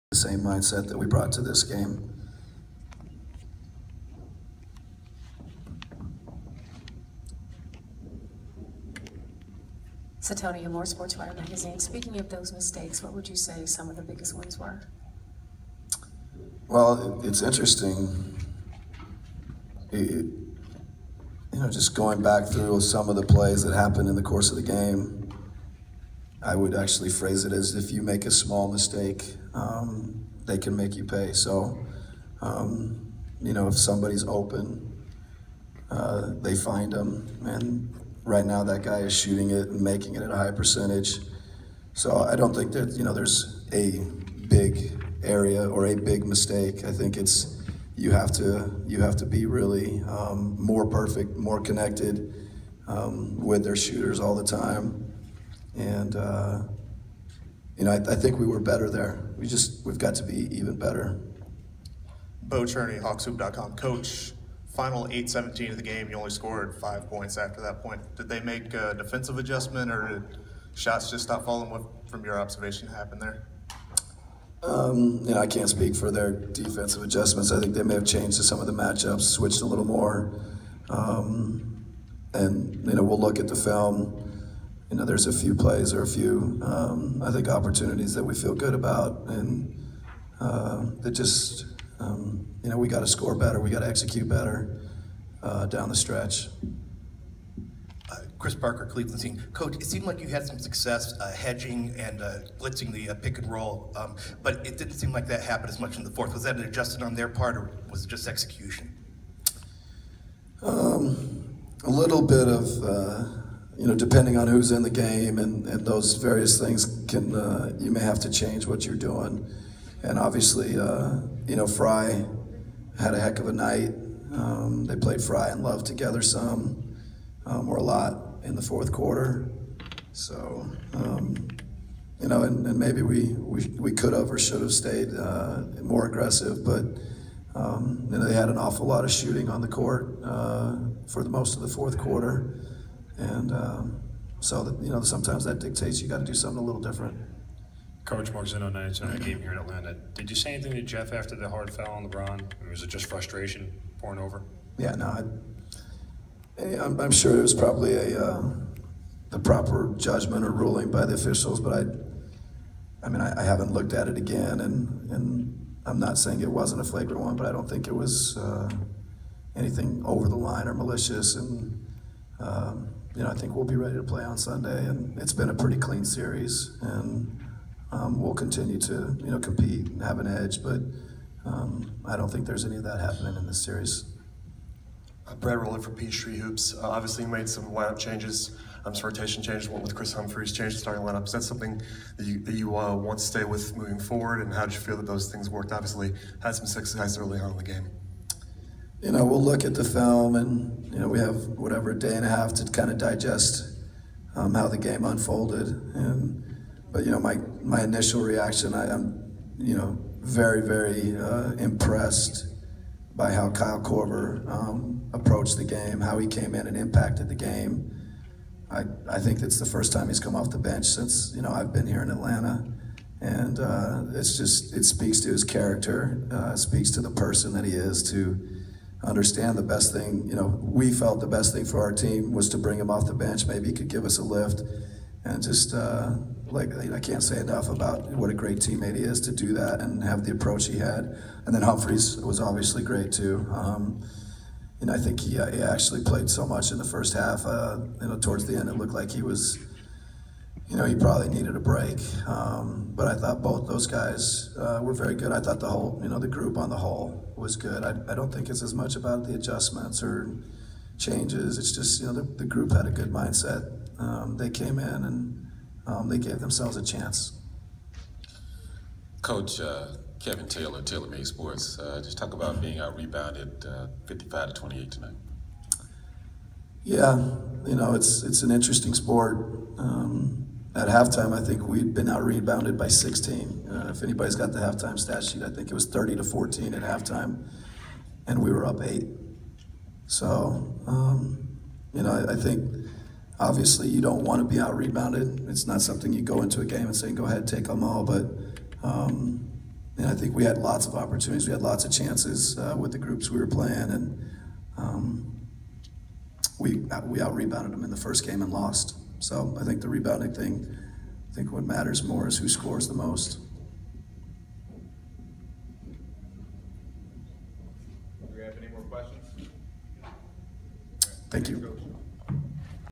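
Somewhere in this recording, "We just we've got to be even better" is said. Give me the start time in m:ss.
0:59.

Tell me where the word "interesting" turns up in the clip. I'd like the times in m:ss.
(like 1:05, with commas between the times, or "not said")
0:17, 4:38.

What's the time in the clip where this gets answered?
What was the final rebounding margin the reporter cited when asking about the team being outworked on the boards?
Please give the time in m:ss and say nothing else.
4:34.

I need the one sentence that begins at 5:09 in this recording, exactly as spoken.
So I think the rebounding thing, I think what matters more is who scores the most.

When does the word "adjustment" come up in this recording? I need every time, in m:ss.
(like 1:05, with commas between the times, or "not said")
1:09, 1:17, 1:46, 4:19.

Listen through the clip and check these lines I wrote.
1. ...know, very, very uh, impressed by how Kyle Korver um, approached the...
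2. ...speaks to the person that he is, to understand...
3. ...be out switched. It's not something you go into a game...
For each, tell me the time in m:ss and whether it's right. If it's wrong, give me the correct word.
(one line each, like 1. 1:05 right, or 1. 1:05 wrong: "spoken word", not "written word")
1. 3:29 right
2. 3:46 right
3. 4:54 wrong: "rebounded", not "switched".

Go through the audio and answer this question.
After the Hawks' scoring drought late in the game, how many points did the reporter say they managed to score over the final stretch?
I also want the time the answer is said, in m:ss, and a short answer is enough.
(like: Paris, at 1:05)
5, at 1:06.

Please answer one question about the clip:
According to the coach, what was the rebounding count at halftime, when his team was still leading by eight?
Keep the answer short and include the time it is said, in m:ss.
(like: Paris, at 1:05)
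30 to 14, at 4:45.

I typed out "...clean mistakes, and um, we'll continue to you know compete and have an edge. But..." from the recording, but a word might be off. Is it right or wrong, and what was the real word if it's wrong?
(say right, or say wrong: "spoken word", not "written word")
wrong: "series", not "mistakes".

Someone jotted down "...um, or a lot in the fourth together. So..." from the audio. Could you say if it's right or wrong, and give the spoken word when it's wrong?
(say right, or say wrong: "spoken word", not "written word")
wrong: "quarter", not "together".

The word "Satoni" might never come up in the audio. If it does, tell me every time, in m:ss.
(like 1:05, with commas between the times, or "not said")
0:10.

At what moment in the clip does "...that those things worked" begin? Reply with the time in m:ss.
3:14.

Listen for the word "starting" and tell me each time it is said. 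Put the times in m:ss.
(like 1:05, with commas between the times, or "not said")
3:10.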